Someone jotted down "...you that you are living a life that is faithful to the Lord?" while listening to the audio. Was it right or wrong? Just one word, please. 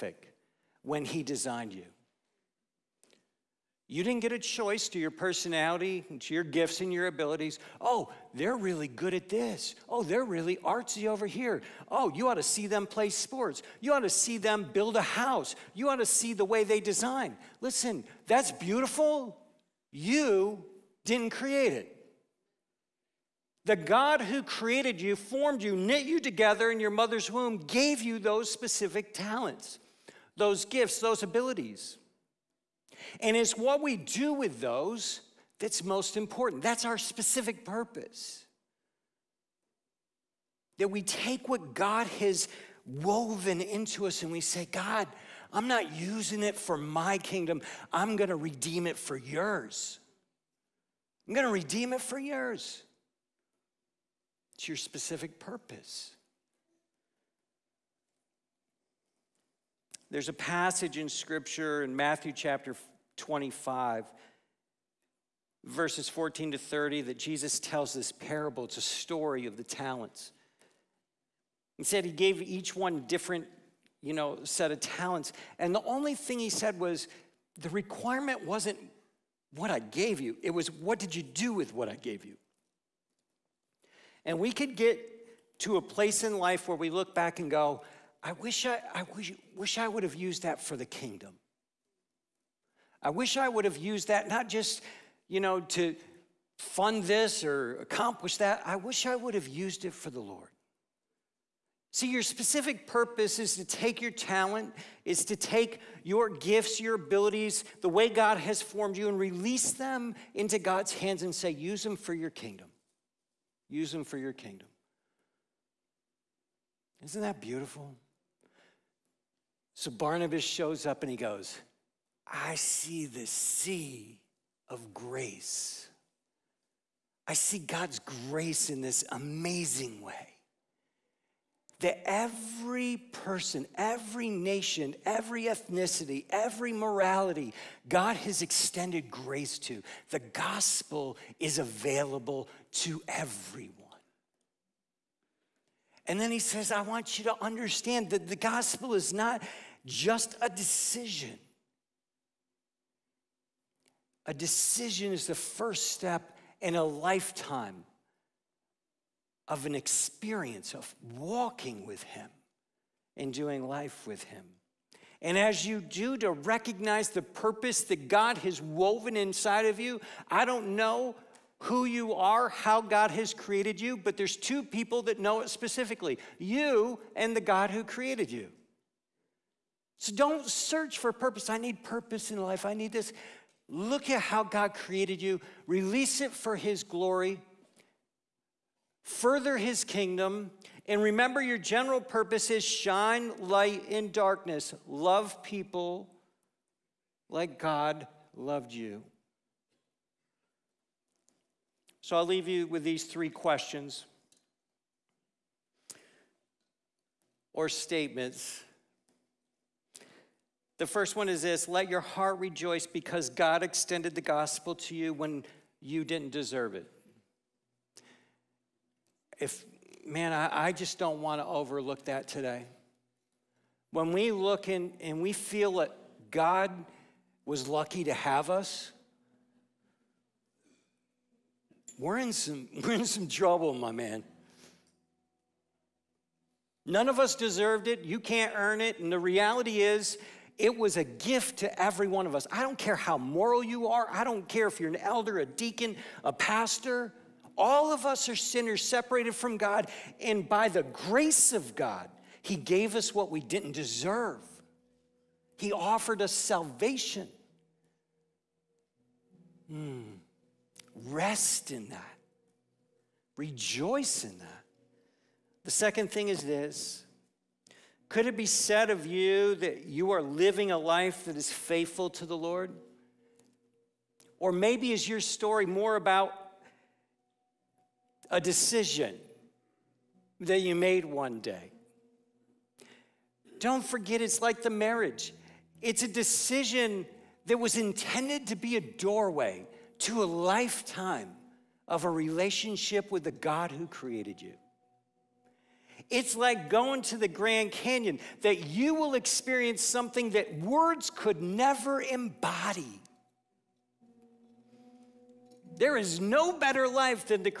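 right.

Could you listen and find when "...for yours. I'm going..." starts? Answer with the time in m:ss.
0:48.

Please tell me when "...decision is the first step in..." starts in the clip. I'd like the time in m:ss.
2:34.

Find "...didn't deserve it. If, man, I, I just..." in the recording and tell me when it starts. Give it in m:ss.
3:36.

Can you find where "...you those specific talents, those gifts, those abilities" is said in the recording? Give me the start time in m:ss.
0:28.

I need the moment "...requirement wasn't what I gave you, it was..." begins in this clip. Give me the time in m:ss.
1:17.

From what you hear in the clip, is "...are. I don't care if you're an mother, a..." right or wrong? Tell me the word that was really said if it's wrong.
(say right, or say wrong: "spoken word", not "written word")
wrong: "elder", not "mother".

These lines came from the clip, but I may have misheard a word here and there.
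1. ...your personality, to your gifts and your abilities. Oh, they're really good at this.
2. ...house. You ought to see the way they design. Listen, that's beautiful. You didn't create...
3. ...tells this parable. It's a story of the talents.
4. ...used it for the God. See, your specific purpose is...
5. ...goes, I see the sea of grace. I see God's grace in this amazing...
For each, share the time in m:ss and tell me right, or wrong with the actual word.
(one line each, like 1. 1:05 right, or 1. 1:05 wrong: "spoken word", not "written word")
1. 0:04 right
2. 0:15 right
3. 1:07 right
4. 1:39 wrong: "Lord", not "God"
5. 2:01 right.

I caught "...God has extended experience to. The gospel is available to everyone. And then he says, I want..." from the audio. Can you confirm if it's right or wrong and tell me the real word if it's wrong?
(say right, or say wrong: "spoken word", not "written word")
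wrong: "grace", not "experience".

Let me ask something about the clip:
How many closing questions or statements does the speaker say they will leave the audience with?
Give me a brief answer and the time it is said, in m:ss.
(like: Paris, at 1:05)
3, at 3:23.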